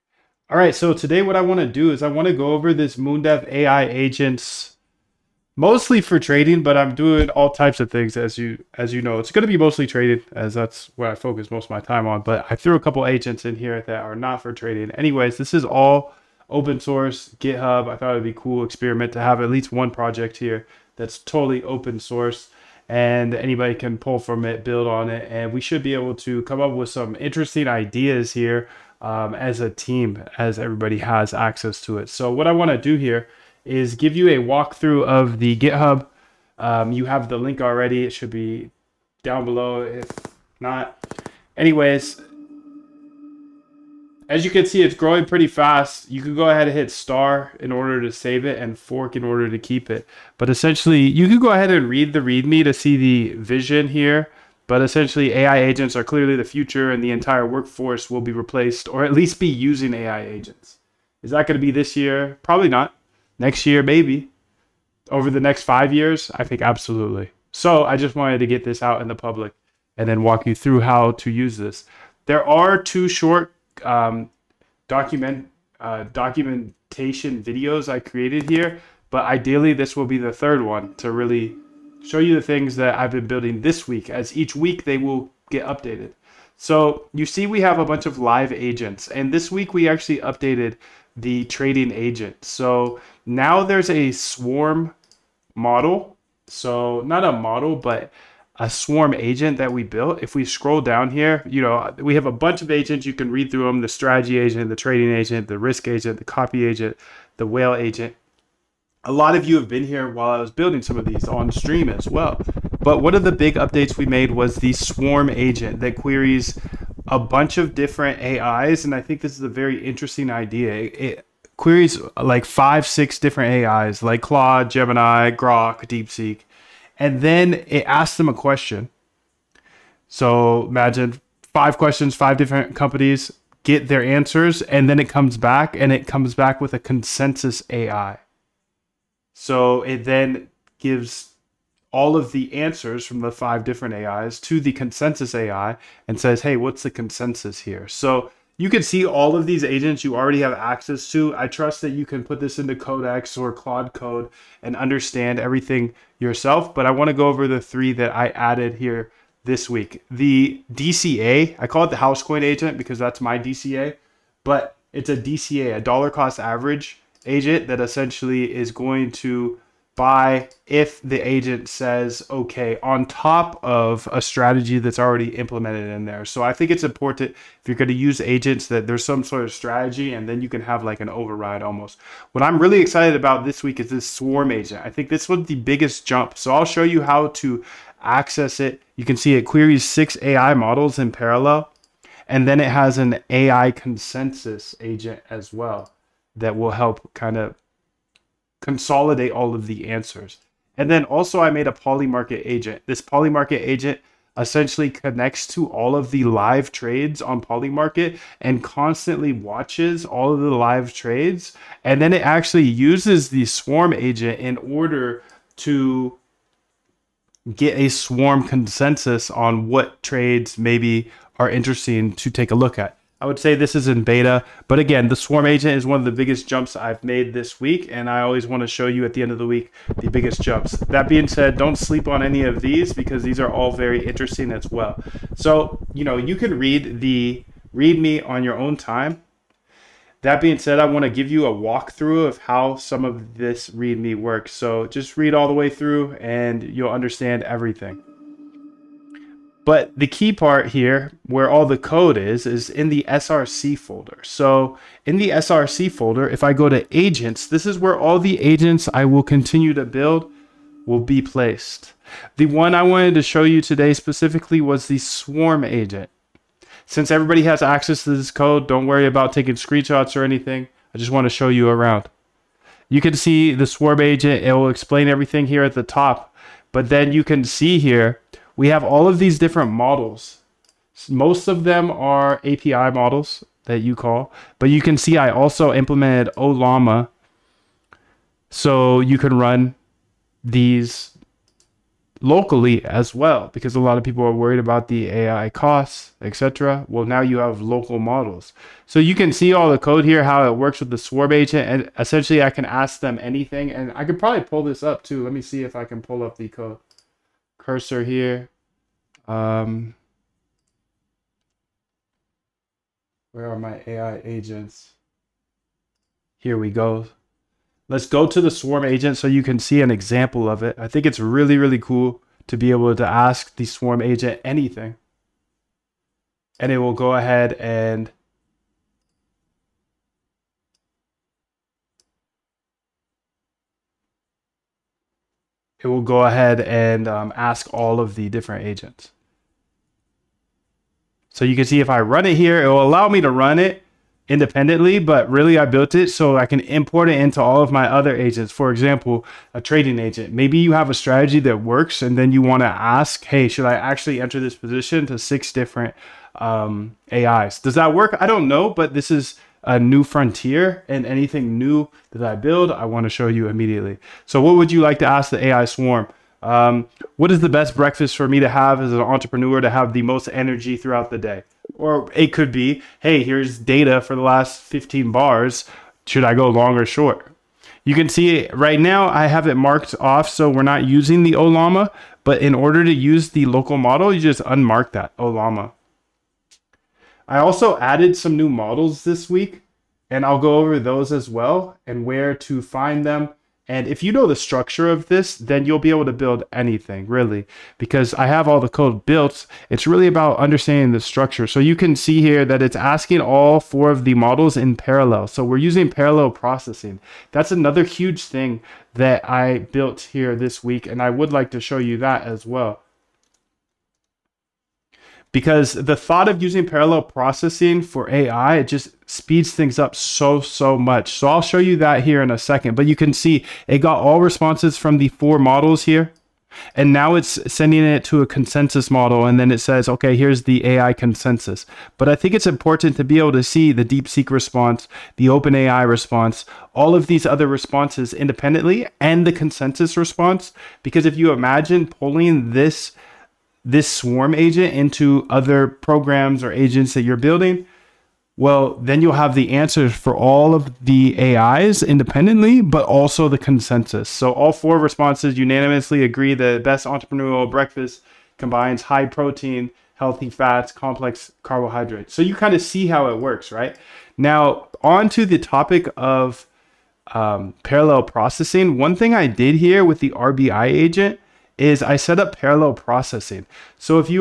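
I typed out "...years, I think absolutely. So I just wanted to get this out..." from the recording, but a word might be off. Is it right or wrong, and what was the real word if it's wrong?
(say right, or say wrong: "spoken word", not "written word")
right.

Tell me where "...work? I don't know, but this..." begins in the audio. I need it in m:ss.
5:57.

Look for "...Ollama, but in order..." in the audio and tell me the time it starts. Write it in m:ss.
6:21.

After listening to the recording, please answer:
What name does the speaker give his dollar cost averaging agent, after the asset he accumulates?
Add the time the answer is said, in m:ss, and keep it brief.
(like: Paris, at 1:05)
Housecoin agent, at 2:41.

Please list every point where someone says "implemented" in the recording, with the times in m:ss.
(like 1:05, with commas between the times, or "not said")
2:55, 4:45.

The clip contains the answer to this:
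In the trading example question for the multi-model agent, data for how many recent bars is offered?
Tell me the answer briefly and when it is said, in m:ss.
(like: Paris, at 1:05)
15, at 6:14.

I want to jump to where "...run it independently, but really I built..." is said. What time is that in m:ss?
5:43.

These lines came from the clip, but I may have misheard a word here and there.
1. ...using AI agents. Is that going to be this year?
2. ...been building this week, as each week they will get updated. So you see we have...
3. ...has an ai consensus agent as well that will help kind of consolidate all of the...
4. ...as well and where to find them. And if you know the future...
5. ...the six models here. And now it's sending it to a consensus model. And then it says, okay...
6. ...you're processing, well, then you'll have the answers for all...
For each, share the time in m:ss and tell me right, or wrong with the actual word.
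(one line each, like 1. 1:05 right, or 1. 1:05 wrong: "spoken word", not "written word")
1. 0:59 right
2. 1:23 right
3. 3:12 right
4. 6:31 wrong: "structure", not "future"
5. 7:04 wrong: "four", not "six"
6. 7:27 wrong: "building", not "processing".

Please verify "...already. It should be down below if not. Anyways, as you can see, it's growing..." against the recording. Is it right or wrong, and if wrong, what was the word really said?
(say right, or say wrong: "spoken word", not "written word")
right.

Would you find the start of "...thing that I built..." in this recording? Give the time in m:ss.
6:48.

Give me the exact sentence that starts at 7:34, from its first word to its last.
So all four responses unanimously agree that best entrepreneurial breakfast combines high protein, healthy fats, complex carbohydrates.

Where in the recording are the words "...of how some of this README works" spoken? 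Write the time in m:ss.
4:02.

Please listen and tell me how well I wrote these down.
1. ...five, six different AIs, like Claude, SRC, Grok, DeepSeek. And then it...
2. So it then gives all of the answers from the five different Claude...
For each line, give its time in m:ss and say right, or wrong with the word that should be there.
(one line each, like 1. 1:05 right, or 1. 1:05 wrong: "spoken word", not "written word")
1. 2:02 wrong: "Gemini", not "SRC"
2. 2:19 wrong: "AIs", not "Claude".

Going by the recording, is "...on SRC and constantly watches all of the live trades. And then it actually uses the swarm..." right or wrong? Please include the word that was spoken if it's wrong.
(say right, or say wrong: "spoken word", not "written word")
wrong: "Polymarket", not "SRC".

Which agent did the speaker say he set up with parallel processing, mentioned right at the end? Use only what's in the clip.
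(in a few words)
RBI agent.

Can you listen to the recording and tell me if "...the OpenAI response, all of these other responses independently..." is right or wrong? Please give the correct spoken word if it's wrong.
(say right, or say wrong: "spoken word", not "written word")
right.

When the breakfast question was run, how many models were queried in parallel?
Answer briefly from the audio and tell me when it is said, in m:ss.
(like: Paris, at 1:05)
4, at 6:43.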